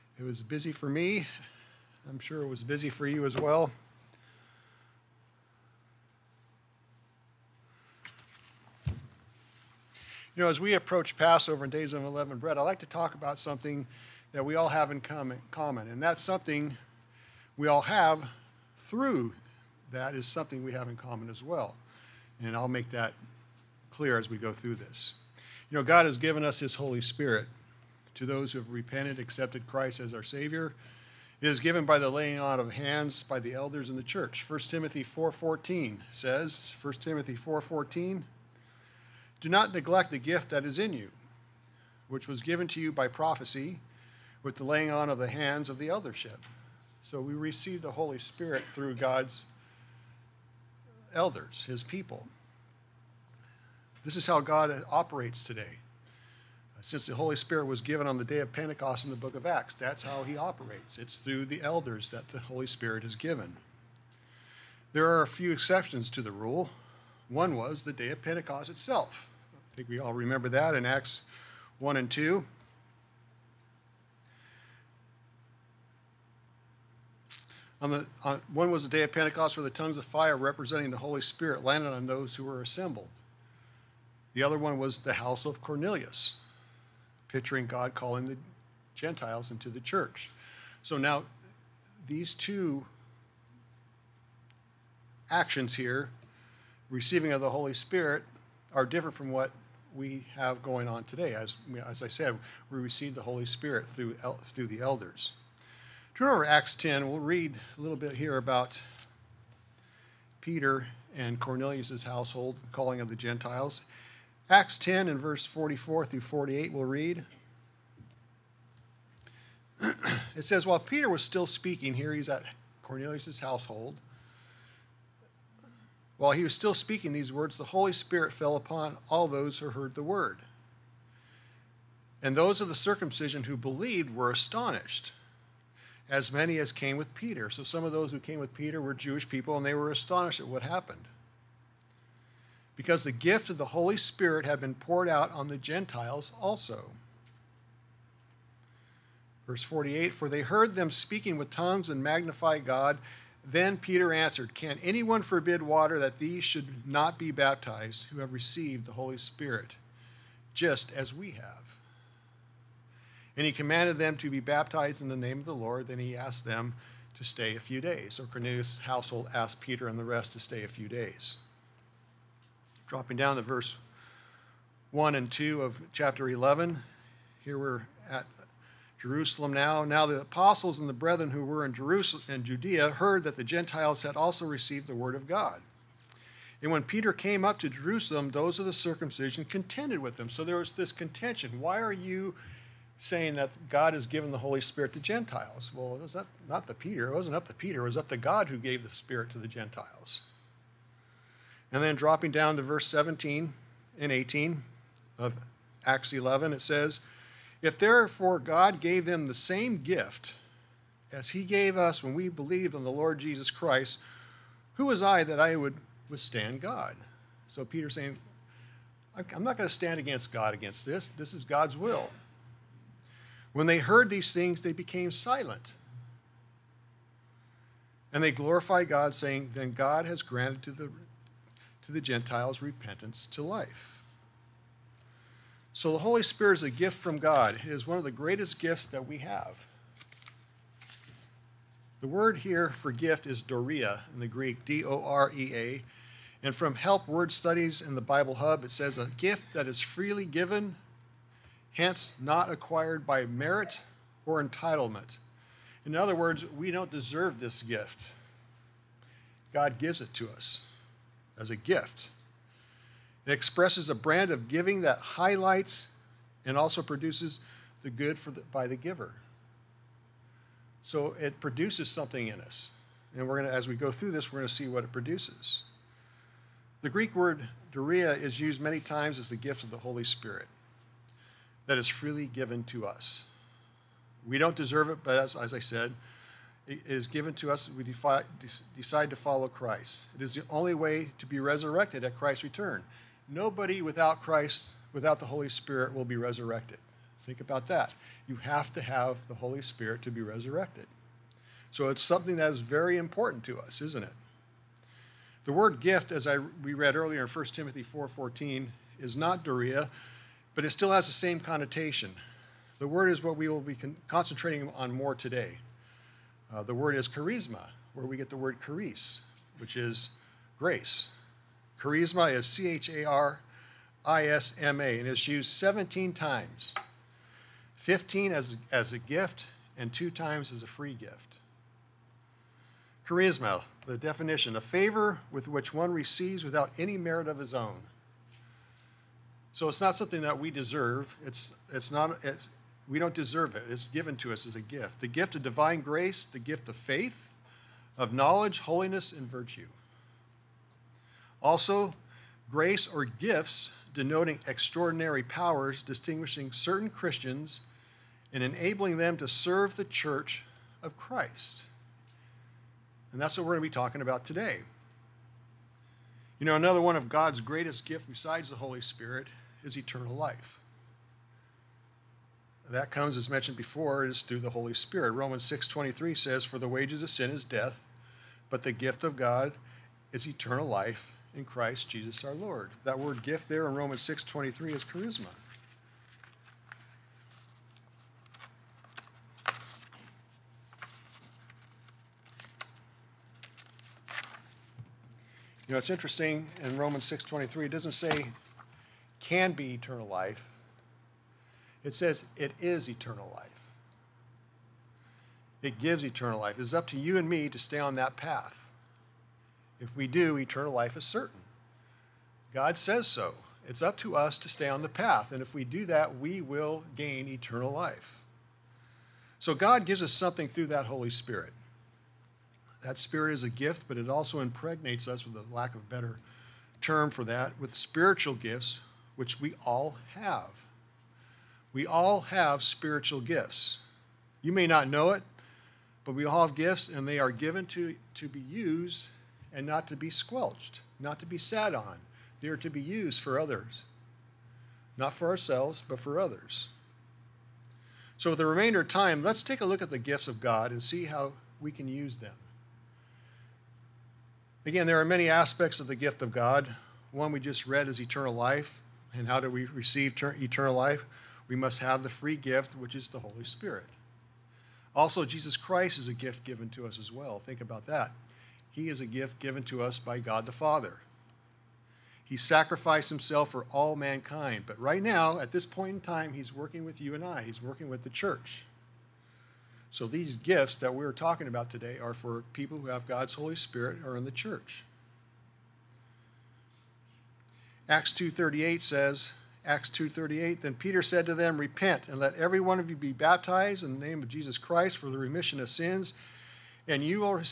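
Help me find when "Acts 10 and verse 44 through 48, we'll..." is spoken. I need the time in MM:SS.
01:54.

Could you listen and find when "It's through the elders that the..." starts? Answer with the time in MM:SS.
01:00.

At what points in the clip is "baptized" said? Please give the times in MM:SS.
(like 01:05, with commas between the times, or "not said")
02:37, 02:44, 08:13.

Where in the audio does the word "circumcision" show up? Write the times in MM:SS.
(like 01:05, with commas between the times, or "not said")
02:12, 03:08.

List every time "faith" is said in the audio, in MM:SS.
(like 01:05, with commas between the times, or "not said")
05:46.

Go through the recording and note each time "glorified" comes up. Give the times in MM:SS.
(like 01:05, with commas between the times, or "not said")
03:48.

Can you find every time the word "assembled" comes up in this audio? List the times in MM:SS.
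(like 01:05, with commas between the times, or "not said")
01:22.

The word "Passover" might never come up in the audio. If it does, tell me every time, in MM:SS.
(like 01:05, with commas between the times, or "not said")
00:11.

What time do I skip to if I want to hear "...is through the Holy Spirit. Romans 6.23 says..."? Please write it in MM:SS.
06:14.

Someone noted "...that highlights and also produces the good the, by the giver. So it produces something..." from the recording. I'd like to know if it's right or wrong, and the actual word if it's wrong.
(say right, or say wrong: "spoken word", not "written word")
right.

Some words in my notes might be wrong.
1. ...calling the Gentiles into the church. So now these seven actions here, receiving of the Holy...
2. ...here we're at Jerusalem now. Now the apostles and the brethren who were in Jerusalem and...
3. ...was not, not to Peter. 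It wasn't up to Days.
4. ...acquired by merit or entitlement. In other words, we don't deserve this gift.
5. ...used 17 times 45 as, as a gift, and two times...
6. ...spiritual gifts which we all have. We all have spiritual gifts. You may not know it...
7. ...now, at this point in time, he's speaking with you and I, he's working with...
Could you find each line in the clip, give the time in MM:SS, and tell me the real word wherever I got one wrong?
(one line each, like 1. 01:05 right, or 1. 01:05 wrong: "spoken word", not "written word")
1. 01:27 wrong: "two", not "seven"
2. 02:57 right
3. 03:16 wrong: "Peter", not "Days"
4. 04:12 right
5. 05:25 wrong: "15", not "45"
6. 07:07 right
7. 07:55 wrong: "working", not "speaking".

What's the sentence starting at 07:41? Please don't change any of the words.
We must have the free gift, which is the Holy Spirit.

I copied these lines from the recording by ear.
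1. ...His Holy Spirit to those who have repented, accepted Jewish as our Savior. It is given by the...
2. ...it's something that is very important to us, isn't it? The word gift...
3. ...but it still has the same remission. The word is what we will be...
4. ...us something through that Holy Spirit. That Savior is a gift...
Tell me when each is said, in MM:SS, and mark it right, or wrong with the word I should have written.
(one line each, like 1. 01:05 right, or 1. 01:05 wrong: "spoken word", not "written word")
1. 00:26 wrong: "Christ", not "Jewish"
2. 05:01 right
3. 05:10 wrong: "connotation", not "remission"
4. 07:00 wrong: "Spirit", not "Savior".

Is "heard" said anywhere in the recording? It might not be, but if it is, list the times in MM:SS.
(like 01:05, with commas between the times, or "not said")
02:09, 02:30, 03:02, 03:43.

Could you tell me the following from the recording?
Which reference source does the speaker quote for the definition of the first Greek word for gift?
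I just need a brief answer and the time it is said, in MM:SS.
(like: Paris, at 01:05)
Help Word Studies, at 04:06.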